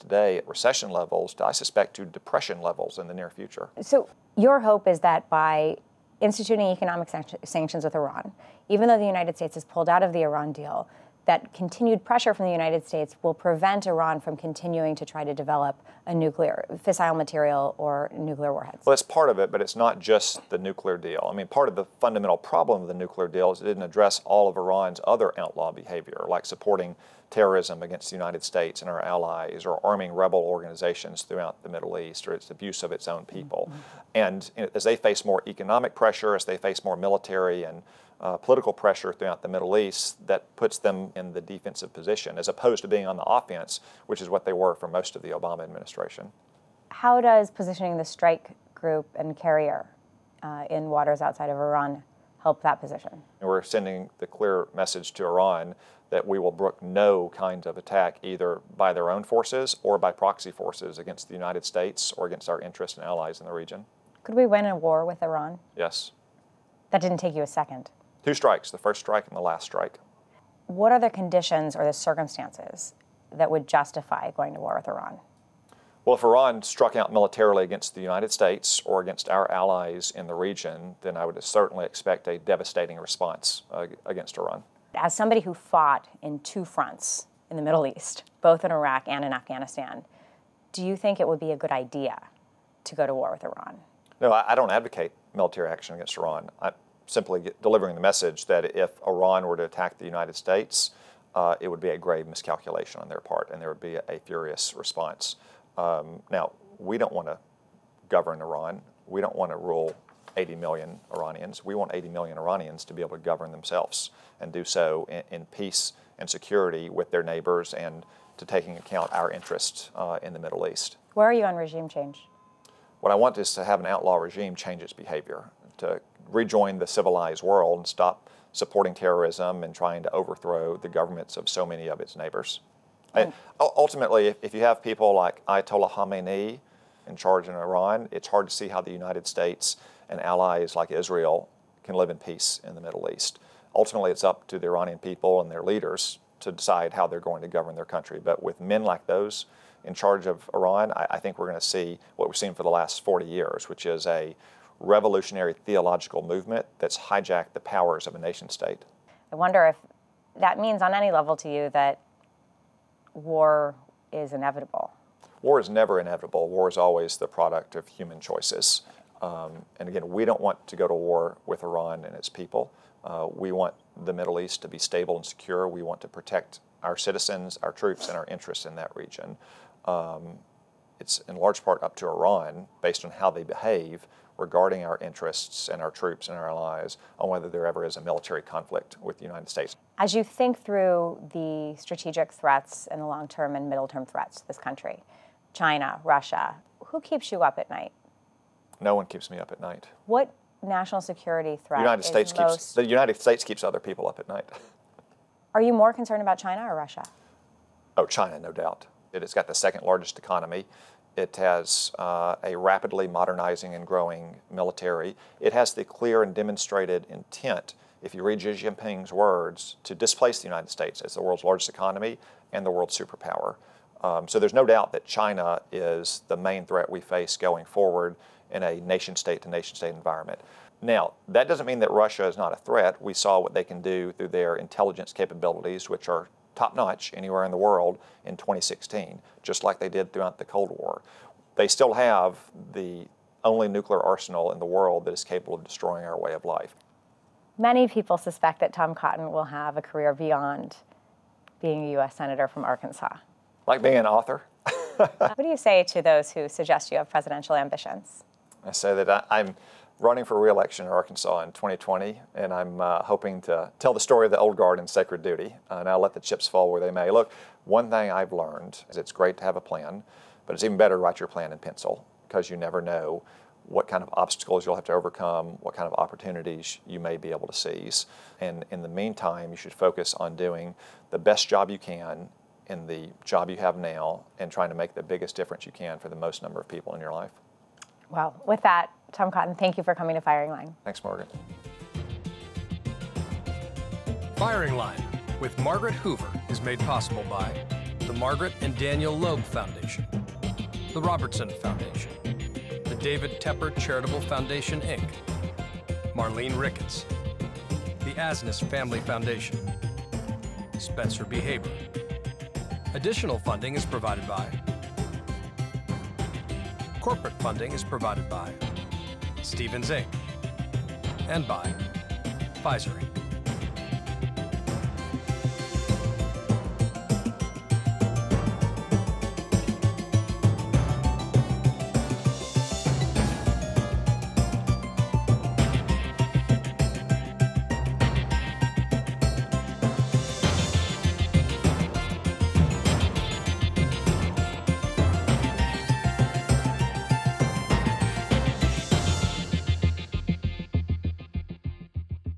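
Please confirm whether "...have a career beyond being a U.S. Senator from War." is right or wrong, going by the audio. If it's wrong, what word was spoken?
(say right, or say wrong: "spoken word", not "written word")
wrong: "Arkansas", not "War".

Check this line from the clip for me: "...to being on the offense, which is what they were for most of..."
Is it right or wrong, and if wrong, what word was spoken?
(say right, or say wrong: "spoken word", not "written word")
right.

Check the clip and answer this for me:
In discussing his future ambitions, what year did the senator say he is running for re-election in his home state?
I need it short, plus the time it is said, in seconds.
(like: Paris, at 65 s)
2020, at 261 s.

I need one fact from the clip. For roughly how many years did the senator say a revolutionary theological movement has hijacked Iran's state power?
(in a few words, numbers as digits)
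40 years.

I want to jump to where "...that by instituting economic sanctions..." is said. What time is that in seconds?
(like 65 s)
5 s.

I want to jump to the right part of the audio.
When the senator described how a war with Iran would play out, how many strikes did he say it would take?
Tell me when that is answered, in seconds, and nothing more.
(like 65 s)
68 s.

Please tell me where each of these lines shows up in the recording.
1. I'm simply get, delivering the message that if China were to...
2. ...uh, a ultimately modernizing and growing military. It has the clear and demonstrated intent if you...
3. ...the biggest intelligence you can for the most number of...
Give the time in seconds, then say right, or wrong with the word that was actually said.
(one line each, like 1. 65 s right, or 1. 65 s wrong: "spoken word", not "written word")
1. 96 s wrong: "Iran", not "China"
2. 211 s wrong: "rapidly", not "ultimately"
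3. 284 s wrong: "difference", not "intelligence".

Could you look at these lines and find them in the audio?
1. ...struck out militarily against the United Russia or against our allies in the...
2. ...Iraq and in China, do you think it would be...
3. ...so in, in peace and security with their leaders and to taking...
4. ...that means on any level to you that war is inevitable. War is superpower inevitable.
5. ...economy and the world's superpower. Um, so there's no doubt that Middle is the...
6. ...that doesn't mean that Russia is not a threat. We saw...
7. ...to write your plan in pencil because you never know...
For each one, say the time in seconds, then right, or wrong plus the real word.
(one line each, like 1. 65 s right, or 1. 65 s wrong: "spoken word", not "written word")
1. 76 s wrong: "States", not "Russia"
2. 88 s wrong: "Afghanistan", not "China"
3. 114 s wrong: "neighbors", not "leaders"
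4. 160 s wrong: "never", not "superpower"
5. 221 s wrong: "China", not "Middle"
6. 231 s right
7. 270 s right.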